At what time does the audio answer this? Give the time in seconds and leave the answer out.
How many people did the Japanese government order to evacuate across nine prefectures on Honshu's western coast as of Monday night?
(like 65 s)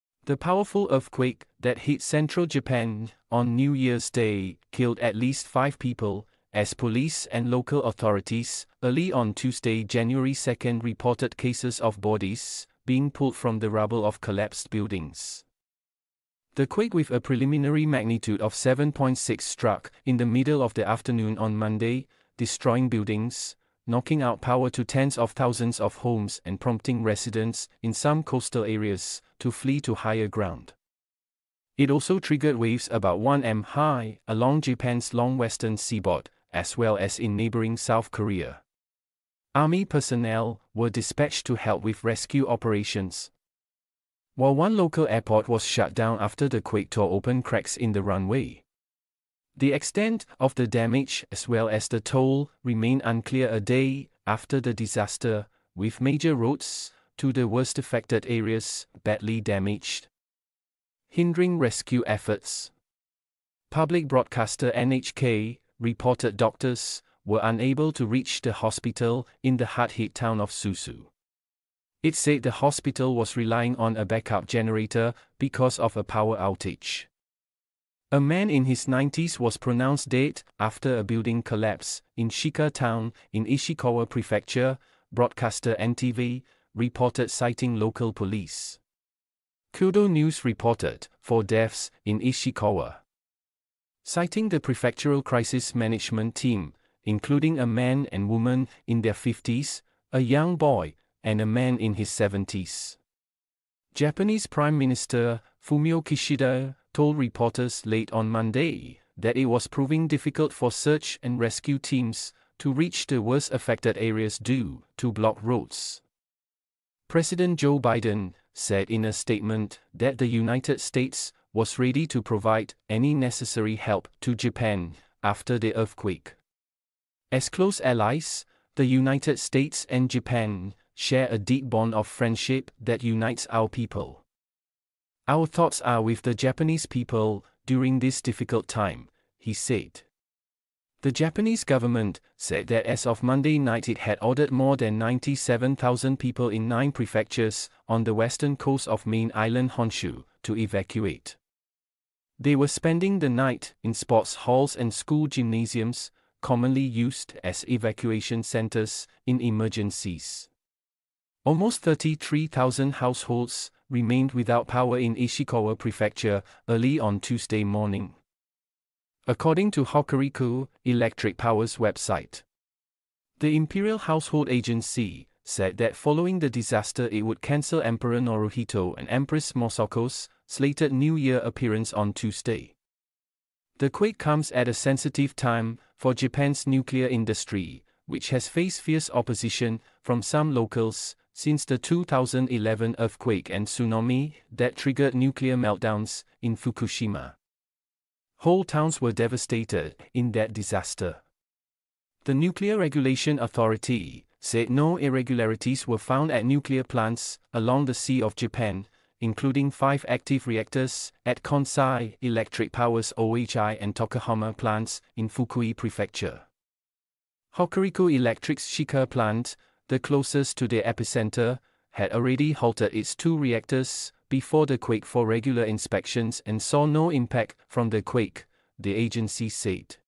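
144 s.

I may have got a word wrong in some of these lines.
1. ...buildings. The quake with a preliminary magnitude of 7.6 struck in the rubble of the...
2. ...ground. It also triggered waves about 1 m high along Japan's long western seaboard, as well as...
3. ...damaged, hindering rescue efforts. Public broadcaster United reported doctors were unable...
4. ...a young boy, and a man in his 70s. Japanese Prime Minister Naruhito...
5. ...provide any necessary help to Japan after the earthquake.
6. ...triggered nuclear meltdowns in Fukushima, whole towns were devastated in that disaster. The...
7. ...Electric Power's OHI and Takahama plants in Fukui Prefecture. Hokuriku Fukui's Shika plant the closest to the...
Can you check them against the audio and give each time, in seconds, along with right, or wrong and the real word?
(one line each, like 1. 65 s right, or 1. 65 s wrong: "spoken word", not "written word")
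1. 14 s wrong: "middle", not "rubble"
2. 30 s right
3. 59 s wrong: "NHK", not "United"
4. 100 s wrong: "Fumio", not "Naruhito"
5. 122 s right
6. 194 s right
7. 212 s wrong: "Electric", not "Fukui".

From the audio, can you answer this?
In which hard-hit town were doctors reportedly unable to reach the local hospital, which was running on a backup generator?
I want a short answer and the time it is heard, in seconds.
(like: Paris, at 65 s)
Suzu, at 70 s.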